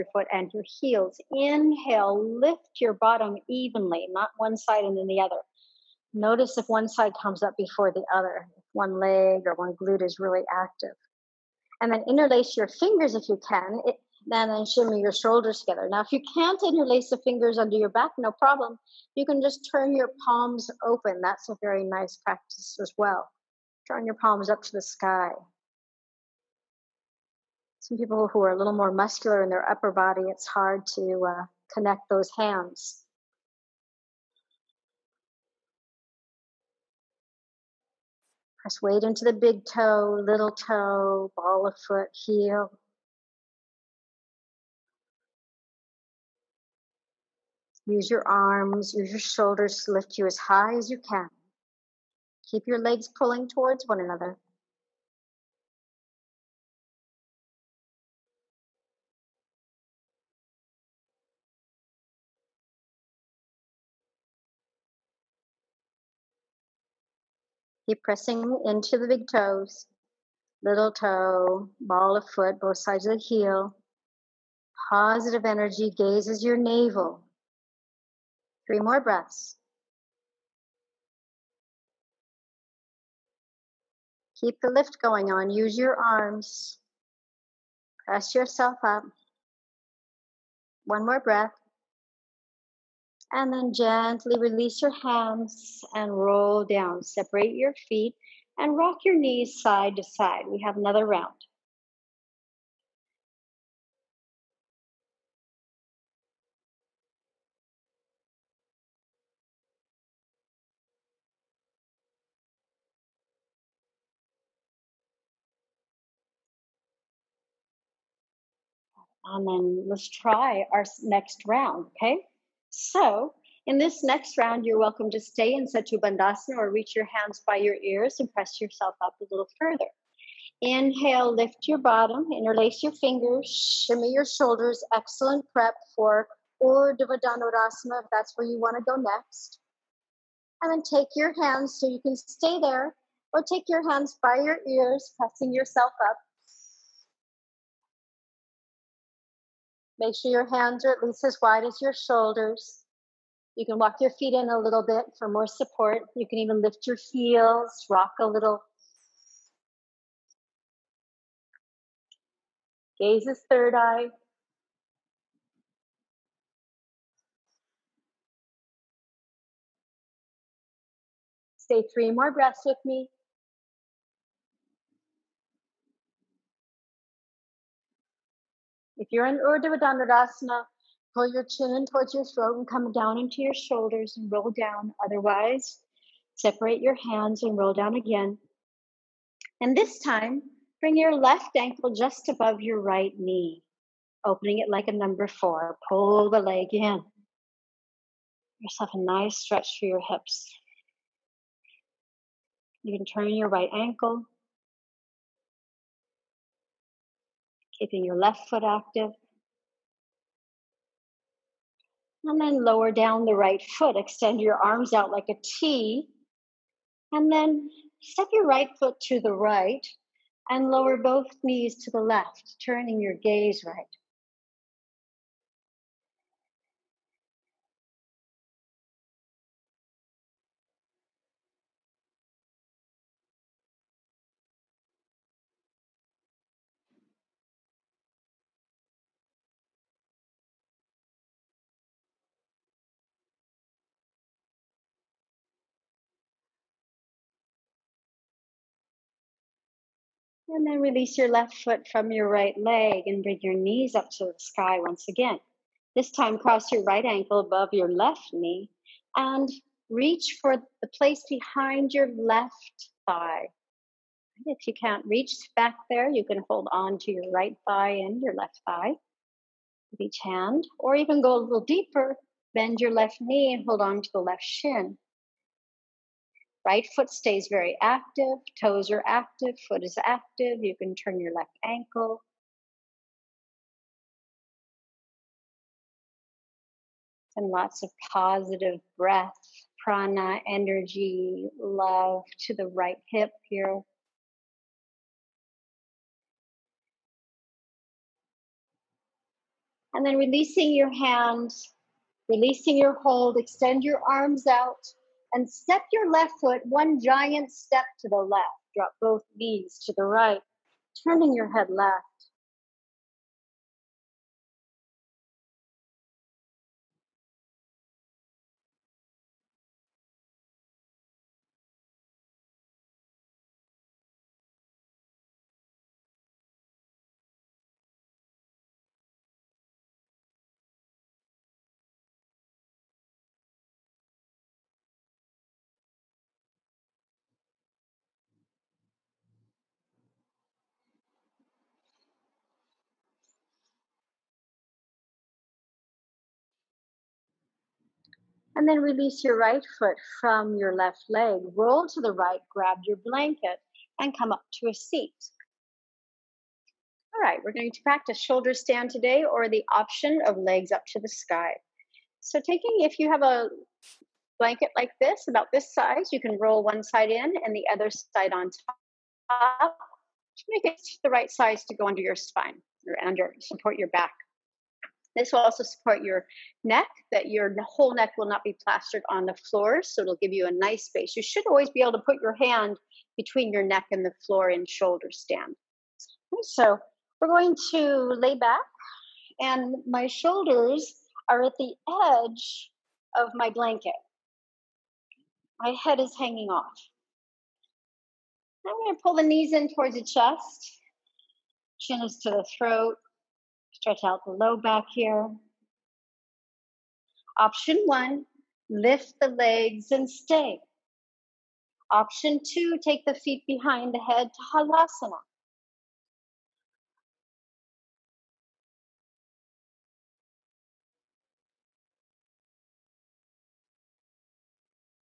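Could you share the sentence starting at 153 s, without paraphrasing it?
You can walk your feet in a little bit for more support.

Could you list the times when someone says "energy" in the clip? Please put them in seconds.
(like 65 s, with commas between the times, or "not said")
75 s, 290 s.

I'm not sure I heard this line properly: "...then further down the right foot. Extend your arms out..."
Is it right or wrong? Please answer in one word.
wrong.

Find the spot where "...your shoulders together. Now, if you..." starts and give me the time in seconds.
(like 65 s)
15 s.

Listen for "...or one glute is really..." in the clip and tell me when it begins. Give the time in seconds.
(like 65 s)
9 s.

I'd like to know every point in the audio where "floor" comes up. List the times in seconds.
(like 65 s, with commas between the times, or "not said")
379 s, 384 s.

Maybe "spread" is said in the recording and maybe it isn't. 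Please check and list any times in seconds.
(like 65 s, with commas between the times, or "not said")
not said.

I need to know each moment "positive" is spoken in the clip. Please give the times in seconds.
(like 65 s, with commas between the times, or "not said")
74 s, 288 s.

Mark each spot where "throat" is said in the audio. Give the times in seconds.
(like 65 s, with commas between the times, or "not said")
182 s, 402 s.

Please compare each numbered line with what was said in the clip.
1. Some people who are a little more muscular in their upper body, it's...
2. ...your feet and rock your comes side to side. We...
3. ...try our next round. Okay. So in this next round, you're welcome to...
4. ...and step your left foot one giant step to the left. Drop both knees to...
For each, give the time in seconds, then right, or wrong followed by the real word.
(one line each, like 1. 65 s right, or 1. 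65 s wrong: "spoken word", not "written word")
1. 27 s right
2. 97 s wrong: "knees", not "comes"
3. 120 s right
4. 305 s right.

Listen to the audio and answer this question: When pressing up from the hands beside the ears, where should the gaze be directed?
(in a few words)
Third eye.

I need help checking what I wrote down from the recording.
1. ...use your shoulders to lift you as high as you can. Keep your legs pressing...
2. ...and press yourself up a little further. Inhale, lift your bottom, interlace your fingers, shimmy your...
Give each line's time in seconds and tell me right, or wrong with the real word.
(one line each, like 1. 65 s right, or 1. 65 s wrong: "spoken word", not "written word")
1. 48 s wrong: "pulling", not "pressing"
2. 128 s right.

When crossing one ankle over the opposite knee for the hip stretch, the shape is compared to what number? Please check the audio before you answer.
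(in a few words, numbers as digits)
4.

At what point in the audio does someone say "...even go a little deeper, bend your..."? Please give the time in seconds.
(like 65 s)
270 s.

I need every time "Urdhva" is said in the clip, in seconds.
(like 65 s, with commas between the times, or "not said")
136 s, 179 s.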